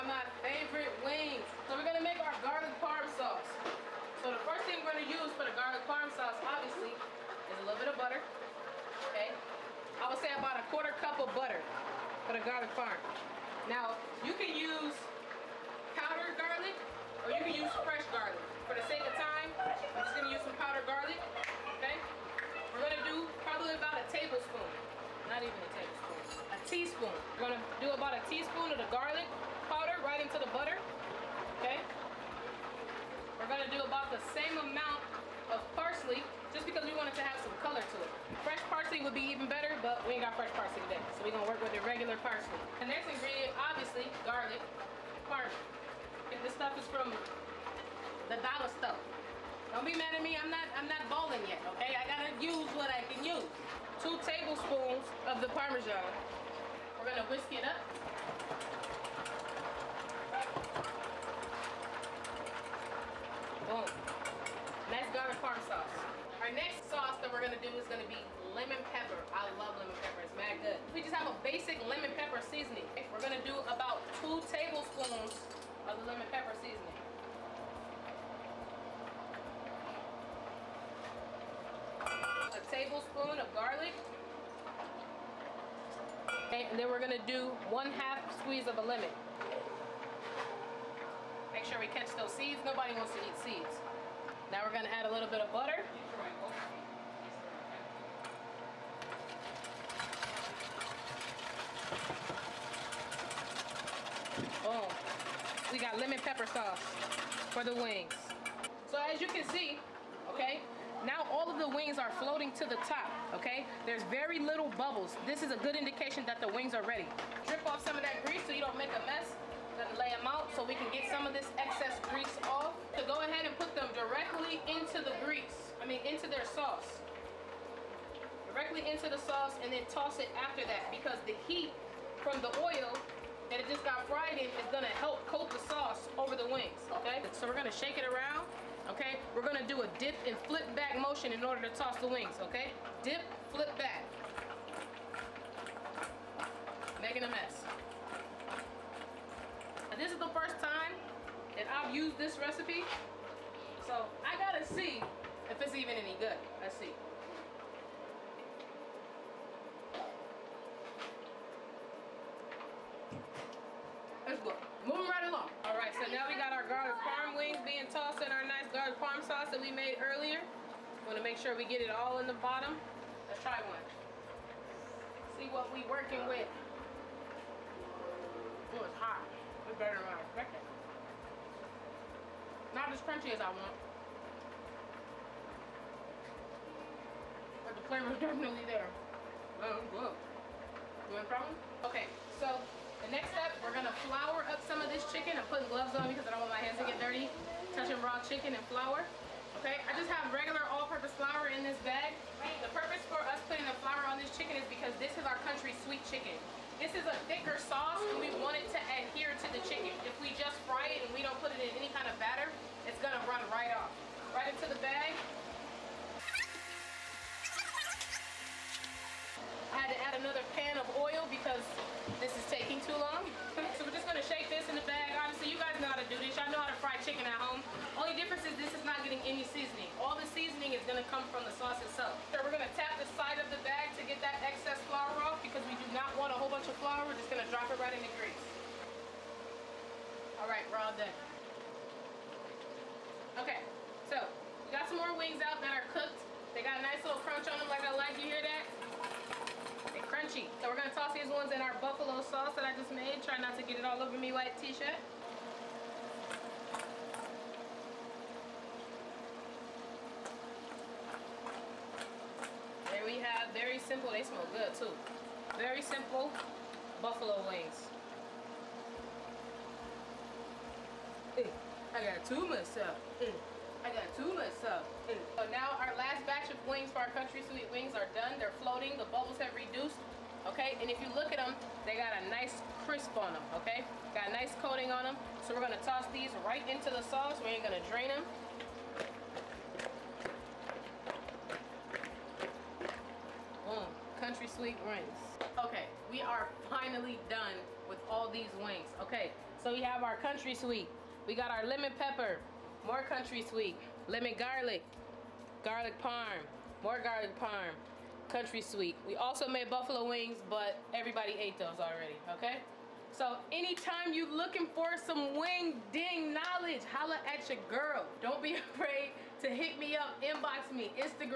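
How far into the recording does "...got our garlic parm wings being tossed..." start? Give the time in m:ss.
2:46.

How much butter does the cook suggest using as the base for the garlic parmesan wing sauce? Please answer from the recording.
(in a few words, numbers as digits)
1/4 cup.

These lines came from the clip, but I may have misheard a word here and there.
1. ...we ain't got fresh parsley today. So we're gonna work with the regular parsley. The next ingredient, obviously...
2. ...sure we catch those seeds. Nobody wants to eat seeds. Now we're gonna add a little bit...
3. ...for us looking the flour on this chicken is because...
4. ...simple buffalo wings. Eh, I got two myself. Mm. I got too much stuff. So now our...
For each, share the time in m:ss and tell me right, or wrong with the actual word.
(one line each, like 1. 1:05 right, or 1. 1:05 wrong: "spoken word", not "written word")
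1. 0:40 right
2. 1:31 right
3. 3:23 wrong: "putting", not "looking"
4. 4:25 right.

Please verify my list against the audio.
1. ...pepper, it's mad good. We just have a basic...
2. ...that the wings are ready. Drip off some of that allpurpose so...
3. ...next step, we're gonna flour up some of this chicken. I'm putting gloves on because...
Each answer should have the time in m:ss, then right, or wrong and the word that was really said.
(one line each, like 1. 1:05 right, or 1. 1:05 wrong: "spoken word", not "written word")
1. 1:10 right
2. 1:56 wrong: "grease", not "allpurpose"
3. 3:13 right.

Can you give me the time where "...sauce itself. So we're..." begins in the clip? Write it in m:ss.
3:51.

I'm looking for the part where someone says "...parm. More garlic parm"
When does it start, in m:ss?
5:05.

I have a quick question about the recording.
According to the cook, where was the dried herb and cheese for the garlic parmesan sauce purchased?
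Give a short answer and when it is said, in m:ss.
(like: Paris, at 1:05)
the dollar store, at 0:48.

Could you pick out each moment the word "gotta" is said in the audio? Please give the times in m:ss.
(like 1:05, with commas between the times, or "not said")
0:52, 2:34.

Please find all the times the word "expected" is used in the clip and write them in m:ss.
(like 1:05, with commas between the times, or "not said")
3:00.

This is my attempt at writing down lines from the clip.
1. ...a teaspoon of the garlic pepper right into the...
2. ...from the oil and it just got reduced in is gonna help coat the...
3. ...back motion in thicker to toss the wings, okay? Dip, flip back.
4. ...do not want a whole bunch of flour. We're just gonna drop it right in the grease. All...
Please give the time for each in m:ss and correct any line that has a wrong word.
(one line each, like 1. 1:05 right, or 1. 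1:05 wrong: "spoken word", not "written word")
1. 0:28 wrong: "powder", not "pepper"
2. 2:12 wrong: "fried", not "reduced"
3. 2:20 wrong: "order", not "thicker"
4. 3:55 right.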